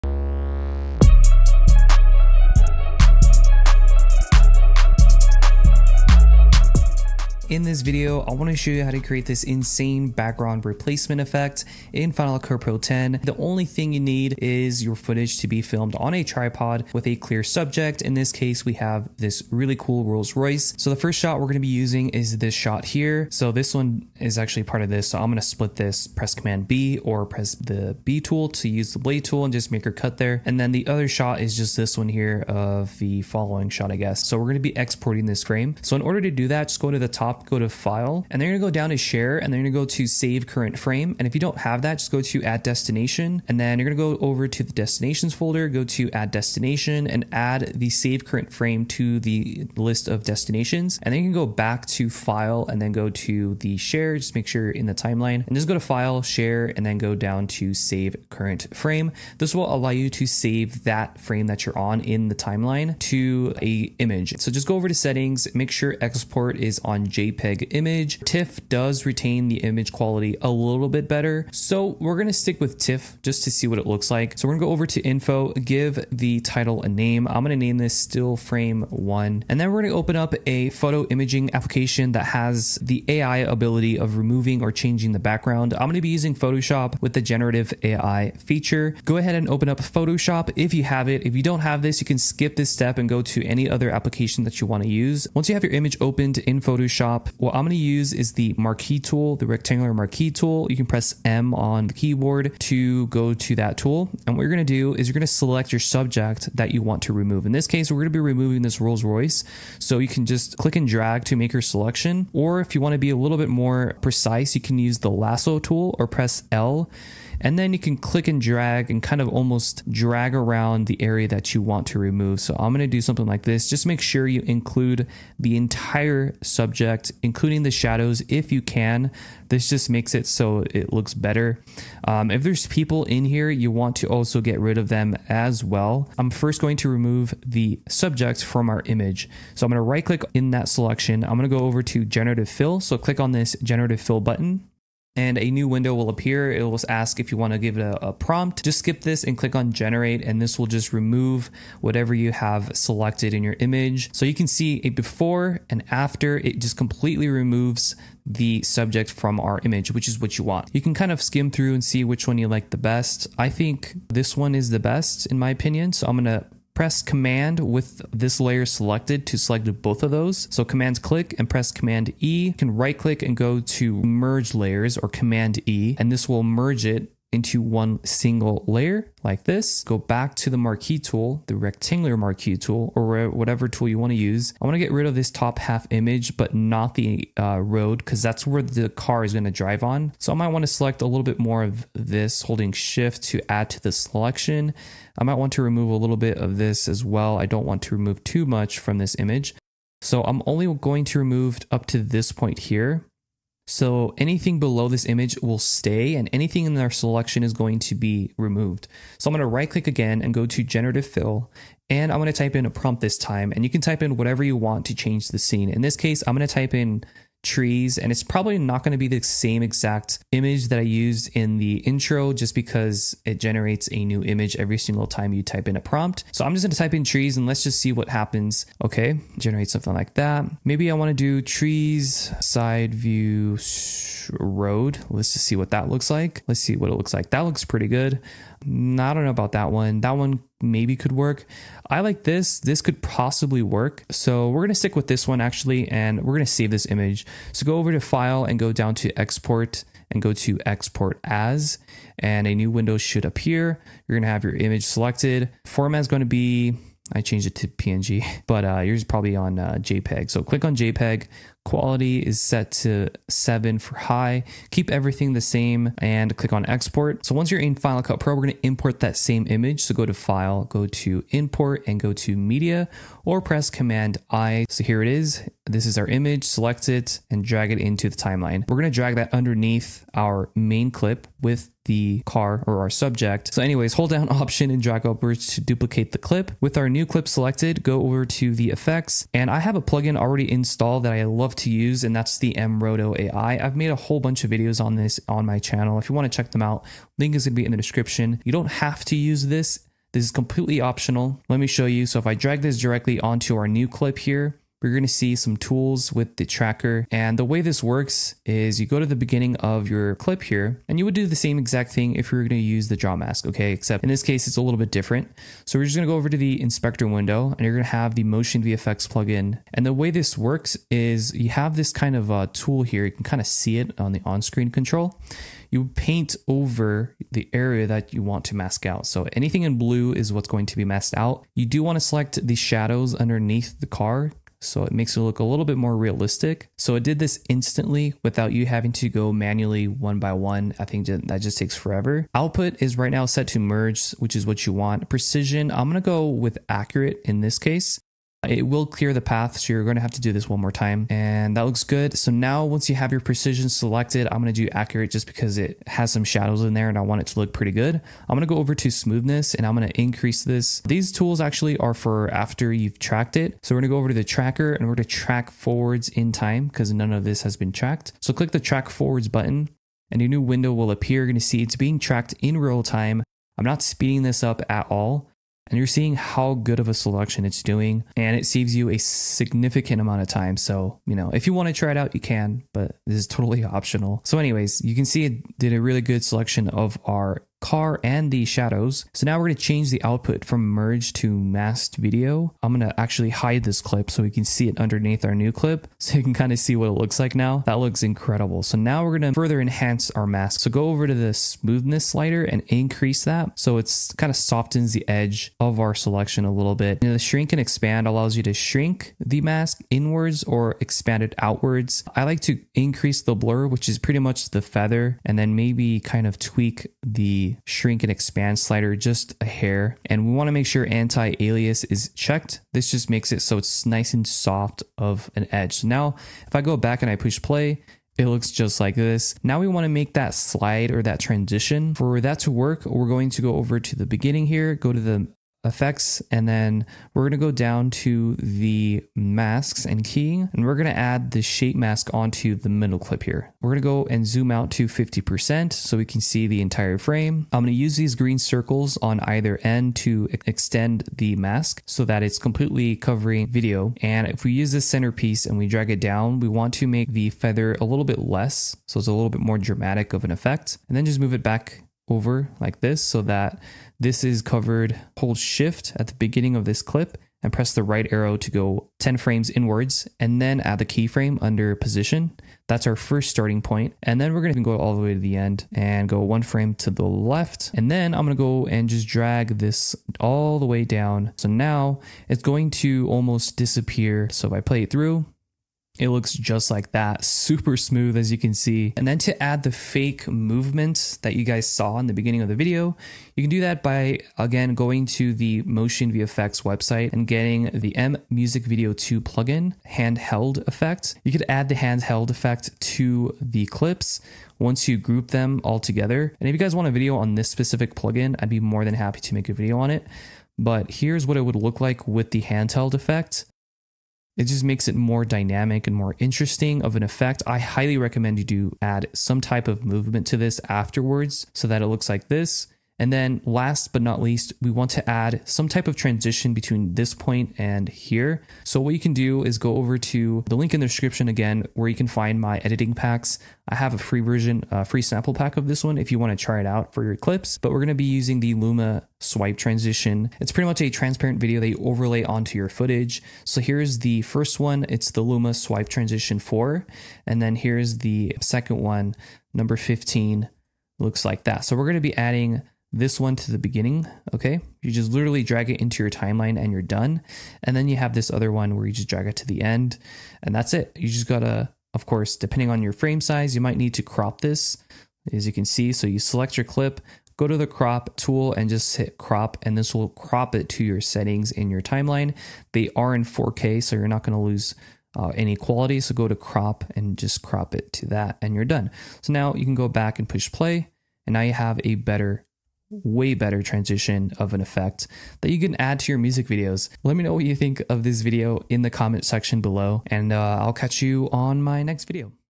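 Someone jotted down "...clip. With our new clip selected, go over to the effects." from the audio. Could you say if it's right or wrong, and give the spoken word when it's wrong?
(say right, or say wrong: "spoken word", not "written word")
right.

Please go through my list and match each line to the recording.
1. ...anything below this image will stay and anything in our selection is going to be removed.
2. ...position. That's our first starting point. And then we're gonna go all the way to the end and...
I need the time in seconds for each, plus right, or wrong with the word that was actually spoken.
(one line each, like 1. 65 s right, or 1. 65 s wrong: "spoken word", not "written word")
1. 204 s right
2. 471 s right.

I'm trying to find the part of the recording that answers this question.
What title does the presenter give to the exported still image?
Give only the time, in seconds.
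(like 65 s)
77 s.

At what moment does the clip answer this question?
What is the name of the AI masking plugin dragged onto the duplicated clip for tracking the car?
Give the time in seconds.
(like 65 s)
292 s.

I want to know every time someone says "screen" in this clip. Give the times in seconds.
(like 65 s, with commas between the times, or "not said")
324 s.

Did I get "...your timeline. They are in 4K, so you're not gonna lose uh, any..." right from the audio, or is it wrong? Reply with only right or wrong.
right.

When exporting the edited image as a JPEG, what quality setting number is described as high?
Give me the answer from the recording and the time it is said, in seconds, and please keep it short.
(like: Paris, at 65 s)
7, at 263 s.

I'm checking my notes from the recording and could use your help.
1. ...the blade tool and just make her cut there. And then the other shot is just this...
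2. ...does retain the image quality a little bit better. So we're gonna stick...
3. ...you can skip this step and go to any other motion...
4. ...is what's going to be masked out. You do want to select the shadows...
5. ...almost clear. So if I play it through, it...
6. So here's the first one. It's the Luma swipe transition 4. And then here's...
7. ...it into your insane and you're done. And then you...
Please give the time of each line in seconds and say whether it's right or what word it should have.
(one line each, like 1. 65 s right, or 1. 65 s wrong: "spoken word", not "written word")
1. 28 s right
2. 68 s right
3. 92 s wrong: "application", not "motion"
4. 330 s right
5. 483 s wrong: "disappear", not "clear"
6. 543 s right
7. 555 s wrong: "timeline", not "insane".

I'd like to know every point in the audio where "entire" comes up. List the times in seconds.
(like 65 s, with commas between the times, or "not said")
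125 s, 446 s.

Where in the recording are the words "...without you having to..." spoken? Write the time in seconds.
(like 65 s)
338 s.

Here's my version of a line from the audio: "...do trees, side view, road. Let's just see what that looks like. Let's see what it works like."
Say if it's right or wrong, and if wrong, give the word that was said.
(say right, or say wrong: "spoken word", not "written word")
wrong: "looks", not "works".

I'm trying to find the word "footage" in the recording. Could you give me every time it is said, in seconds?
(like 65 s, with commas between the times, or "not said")
14 s, 542 s.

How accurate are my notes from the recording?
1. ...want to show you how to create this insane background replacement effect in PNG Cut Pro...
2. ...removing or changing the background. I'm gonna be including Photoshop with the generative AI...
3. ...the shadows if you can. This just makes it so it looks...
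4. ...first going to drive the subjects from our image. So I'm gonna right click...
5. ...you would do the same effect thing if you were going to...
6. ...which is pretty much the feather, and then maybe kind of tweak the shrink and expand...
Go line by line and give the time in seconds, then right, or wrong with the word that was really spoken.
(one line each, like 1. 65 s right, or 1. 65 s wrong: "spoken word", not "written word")
1. 8 s wrong: "Final", not "PNG"
2. 84 s wrong: "using", not "including"
3. 127 s right
4. 136 s wrong: "remove", not "drive"
5. 310 s wrong: "exact", not "effect"
6. 413 s right.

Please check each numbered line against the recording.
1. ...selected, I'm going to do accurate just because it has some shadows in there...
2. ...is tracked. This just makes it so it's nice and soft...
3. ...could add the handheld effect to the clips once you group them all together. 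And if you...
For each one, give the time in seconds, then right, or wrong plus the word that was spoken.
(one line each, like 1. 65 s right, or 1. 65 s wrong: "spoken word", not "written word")
1. 353 s right
2. 421 s wrong: "checked", not "tracked"
3. 501 s right.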